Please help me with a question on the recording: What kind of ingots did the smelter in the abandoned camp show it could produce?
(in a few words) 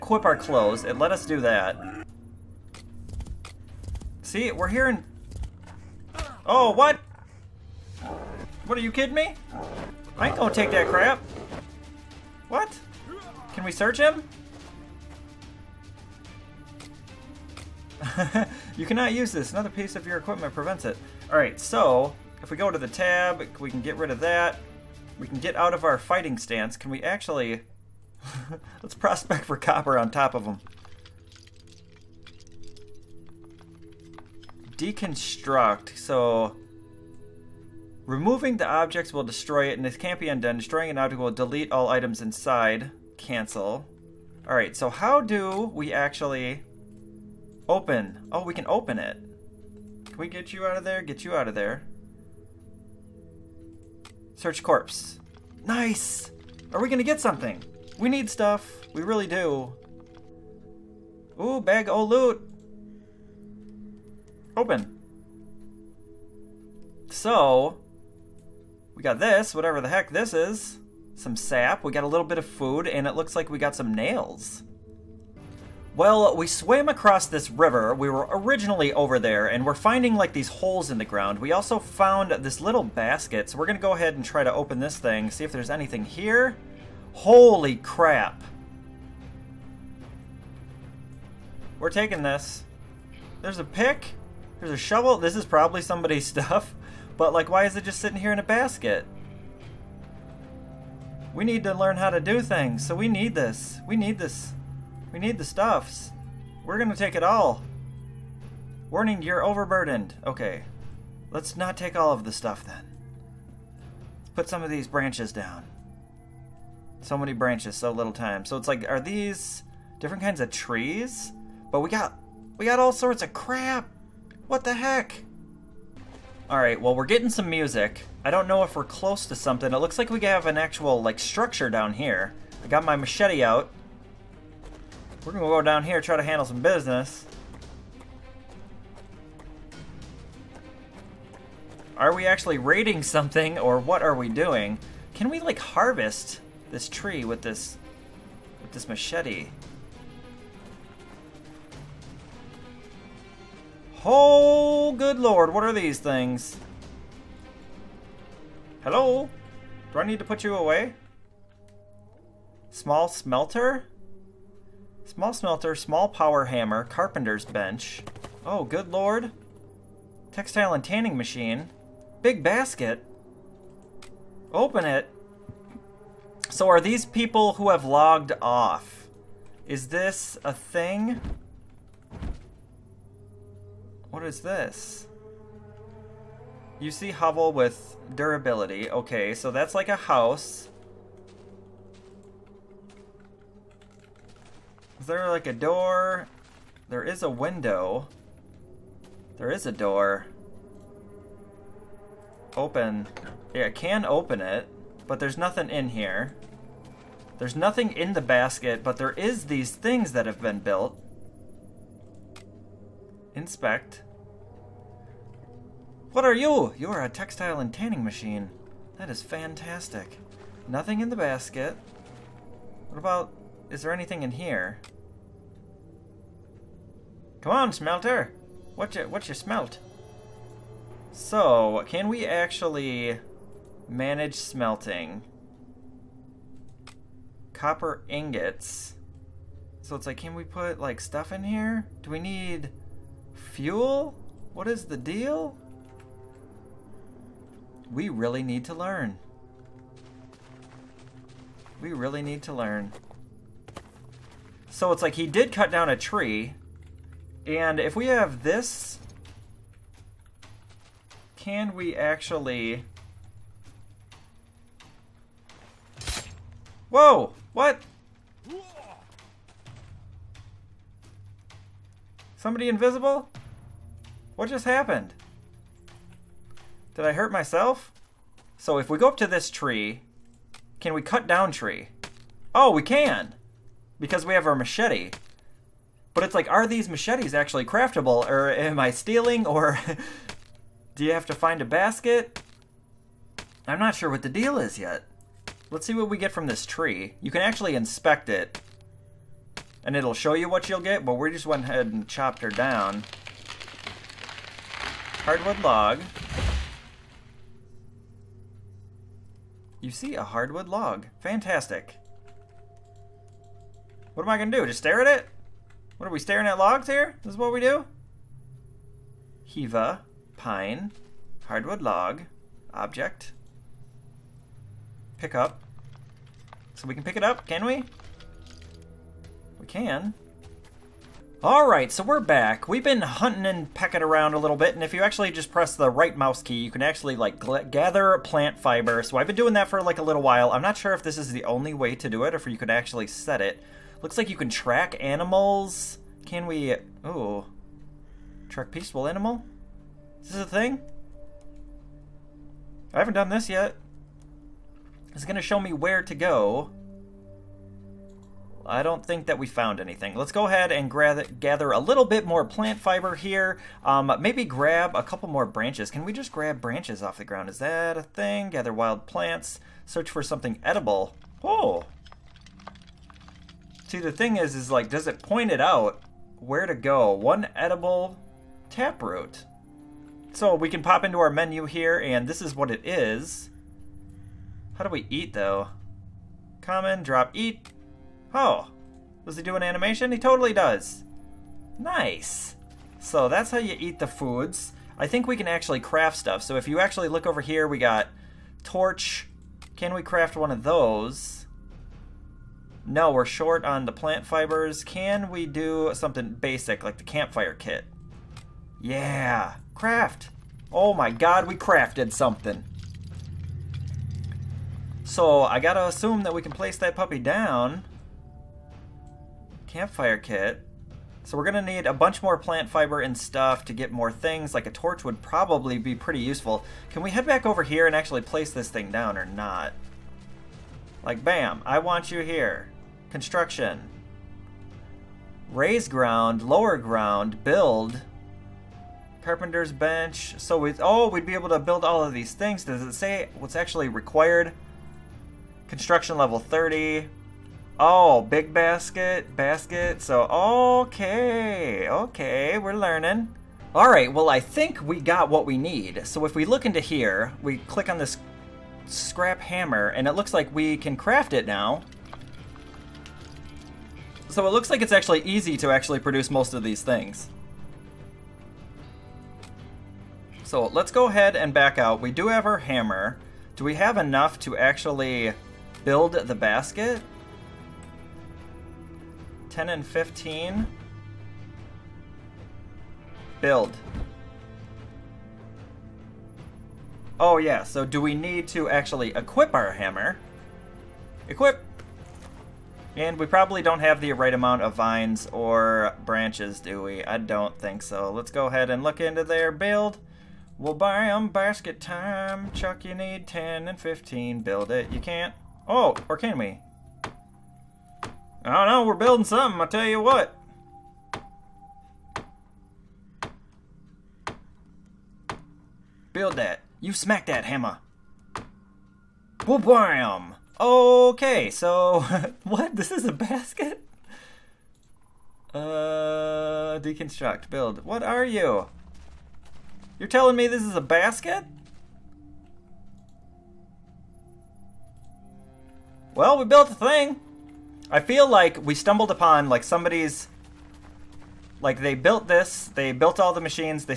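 Copper ingots.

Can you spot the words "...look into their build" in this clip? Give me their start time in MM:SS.
08:18.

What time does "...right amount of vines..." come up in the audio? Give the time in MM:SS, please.
08:14.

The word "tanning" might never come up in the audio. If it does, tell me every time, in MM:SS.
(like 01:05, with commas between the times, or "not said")
02:50, 03:37.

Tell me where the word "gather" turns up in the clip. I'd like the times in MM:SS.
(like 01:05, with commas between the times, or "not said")
05:37, 06:01, 06:08.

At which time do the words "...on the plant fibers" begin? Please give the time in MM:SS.
06:43.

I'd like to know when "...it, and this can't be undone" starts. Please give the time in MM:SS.
00:39.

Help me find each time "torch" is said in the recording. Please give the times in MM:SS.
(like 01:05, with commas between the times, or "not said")
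06:38, 07:04.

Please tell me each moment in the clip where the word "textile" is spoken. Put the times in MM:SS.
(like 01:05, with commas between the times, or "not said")
02:50, 03:37.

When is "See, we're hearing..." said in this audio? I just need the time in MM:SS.
00:04.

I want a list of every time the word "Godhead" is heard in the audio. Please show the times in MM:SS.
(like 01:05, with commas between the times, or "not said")
not said.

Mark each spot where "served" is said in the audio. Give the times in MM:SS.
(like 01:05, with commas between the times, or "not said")
not said.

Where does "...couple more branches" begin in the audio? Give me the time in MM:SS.
06:05.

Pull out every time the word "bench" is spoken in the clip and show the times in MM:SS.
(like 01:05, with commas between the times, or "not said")
02:47, 07:19.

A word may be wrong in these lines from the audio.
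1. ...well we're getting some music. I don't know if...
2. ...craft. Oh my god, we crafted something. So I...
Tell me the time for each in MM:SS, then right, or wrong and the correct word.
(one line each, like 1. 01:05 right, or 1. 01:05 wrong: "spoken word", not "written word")
1. 02:06 right
2. 06:49 right.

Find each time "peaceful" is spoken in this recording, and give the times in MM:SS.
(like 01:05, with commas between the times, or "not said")
05:48.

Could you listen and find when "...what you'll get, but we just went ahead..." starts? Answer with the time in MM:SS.
05:00.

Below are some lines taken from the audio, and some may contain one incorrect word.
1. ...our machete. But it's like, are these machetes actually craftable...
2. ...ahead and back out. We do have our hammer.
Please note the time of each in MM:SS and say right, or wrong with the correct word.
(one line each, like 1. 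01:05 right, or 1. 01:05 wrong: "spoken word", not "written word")
1. 04:44 right
2. 07:51 right.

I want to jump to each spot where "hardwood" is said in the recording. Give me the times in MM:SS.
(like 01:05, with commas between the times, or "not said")
05:05, 05:10, 05:21.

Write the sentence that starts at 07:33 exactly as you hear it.
All right, well, I think we got what we need.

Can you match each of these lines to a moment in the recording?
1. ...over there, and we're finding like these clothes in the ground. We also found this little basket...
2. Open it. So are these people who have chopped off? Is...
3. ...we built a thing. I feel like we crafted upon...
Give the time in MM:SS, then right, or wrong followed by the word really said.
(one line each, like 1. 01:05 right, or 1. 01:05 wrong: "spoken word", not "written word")
1. 01:18 wrong: "holes", not "clothes"
2. 02:54 wrong: "logged", not "chopped"
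3. 08:56 wrong: "stumbled", not "crafted".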